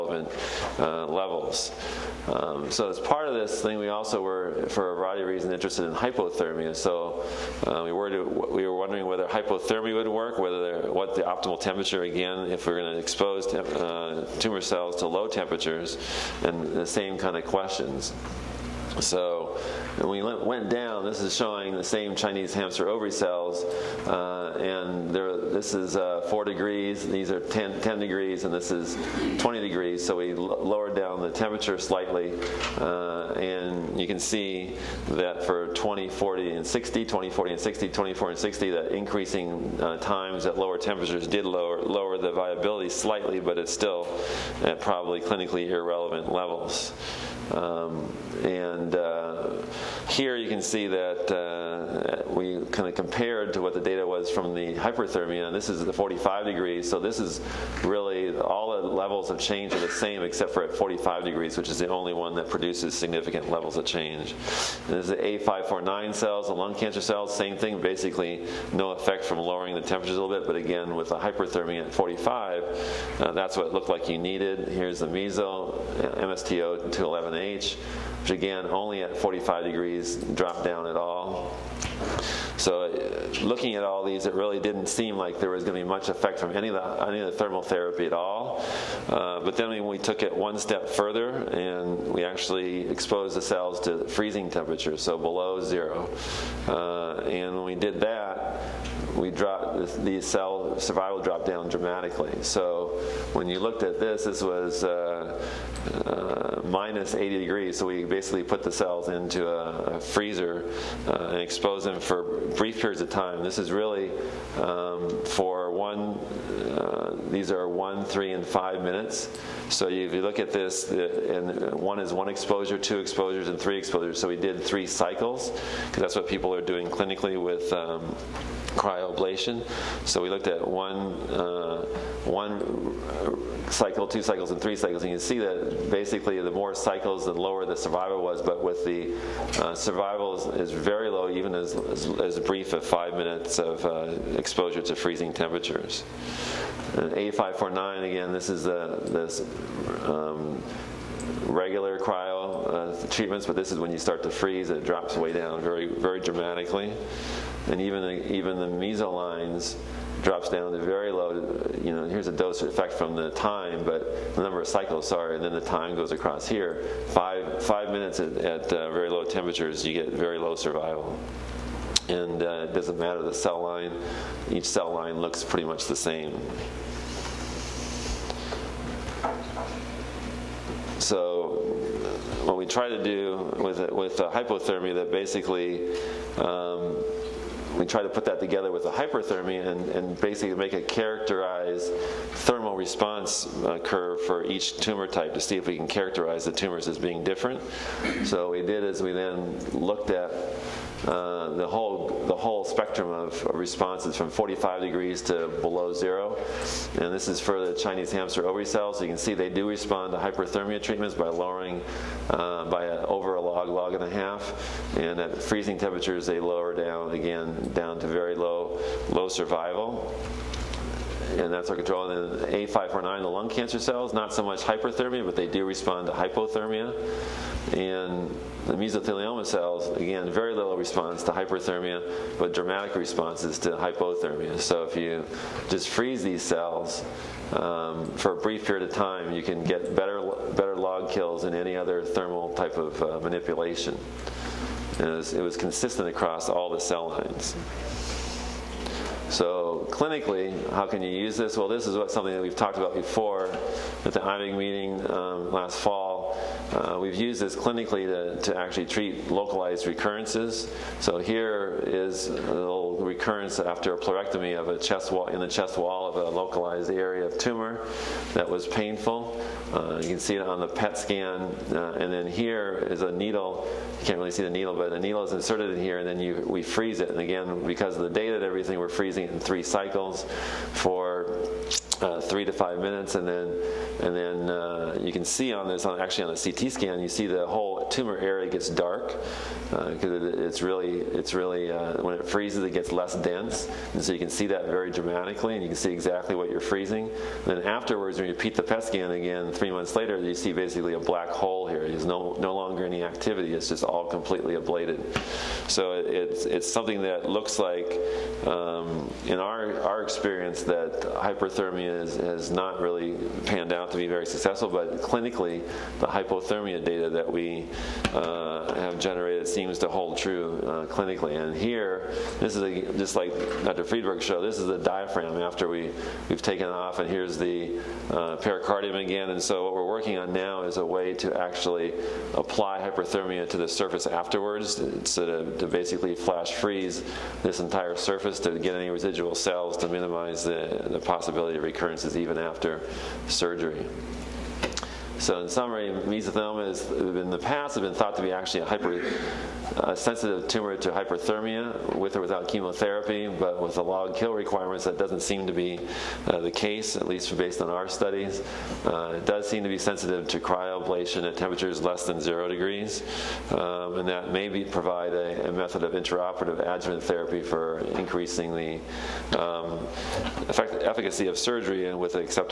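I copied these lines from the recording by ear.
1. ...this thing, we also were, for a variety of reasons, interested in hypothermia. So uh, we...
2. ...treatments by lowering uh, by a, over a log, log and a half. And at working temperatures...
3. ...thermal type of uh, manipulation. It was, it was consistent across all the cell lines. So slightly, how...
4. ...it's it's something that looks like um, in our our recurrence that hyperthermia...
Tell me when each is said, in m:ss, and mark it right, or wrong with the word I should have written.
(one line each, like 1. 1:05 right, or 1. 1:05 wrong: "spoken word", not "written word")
1. 0:03 right
2. 3:30 wrong: "freezing", not "working"
3. 4:02 wrong: "clinically", not "slightly"
4. 5:06 wrong: "experience", not "recurrence".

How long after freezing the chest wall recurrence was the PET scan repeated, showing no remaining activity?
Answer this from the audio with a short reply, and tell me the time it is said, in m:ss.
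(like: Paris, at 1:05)
3 months, at 4:59.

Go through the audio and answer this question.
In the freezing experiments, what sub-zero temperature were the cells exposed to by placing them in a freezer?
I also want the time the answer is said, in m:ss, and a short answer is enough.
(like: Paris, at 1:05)
-80 degrees, at 1:46.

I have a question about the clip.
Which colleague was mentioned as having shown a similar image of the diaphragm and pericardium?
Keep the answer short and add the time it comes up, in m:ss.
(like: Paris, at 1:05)
Dr. Friedberg, at 5:23.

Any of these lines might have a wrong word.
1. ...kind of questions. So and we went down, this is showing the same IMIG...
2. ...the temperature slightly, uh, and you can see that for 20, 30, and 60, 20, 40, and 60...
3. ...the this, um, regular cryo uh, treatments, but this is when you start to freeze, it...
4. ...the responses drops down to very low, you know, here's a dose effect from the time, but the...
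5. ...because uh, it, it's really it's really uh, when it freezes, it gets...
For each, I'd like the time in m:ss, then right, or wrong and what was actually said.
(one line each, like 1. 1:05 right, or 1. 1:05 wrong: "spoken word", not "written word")
1. 0:17 wrong: "Chinese", not "IMIG"
2. 0:31 wrong: "40", not "30"
3. 2:28 right
4. 2:38 wrong: "lines", not "responses"
5. 4:49 right.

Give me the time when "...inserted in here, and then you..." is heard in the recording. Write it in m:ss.
4:35.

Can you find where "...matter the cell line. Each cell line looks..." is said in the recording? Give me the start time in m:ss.
2:52.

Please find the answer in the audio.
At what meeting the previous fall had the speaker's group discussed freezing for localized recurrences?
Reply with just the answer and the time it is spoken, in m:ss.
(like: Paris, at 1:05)
IMIG meeting, at 4:14.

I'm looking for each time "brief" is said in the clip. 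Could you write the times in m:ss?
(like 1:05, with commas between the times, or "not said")
1:52, 2:22, 3:58.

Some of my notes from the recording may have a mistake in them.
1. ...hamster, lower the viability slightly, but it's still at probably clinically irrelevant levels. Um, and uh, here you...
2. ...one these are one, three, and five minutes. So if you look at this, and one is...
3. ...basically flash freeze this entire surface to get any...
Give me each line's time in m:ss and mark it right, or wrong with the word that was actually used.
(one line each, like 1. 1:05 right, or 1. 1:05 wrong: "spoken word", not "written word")
1. 0:41 wrong: "lower", not "hamster"
2. 1:55 right
3. 5:35 right.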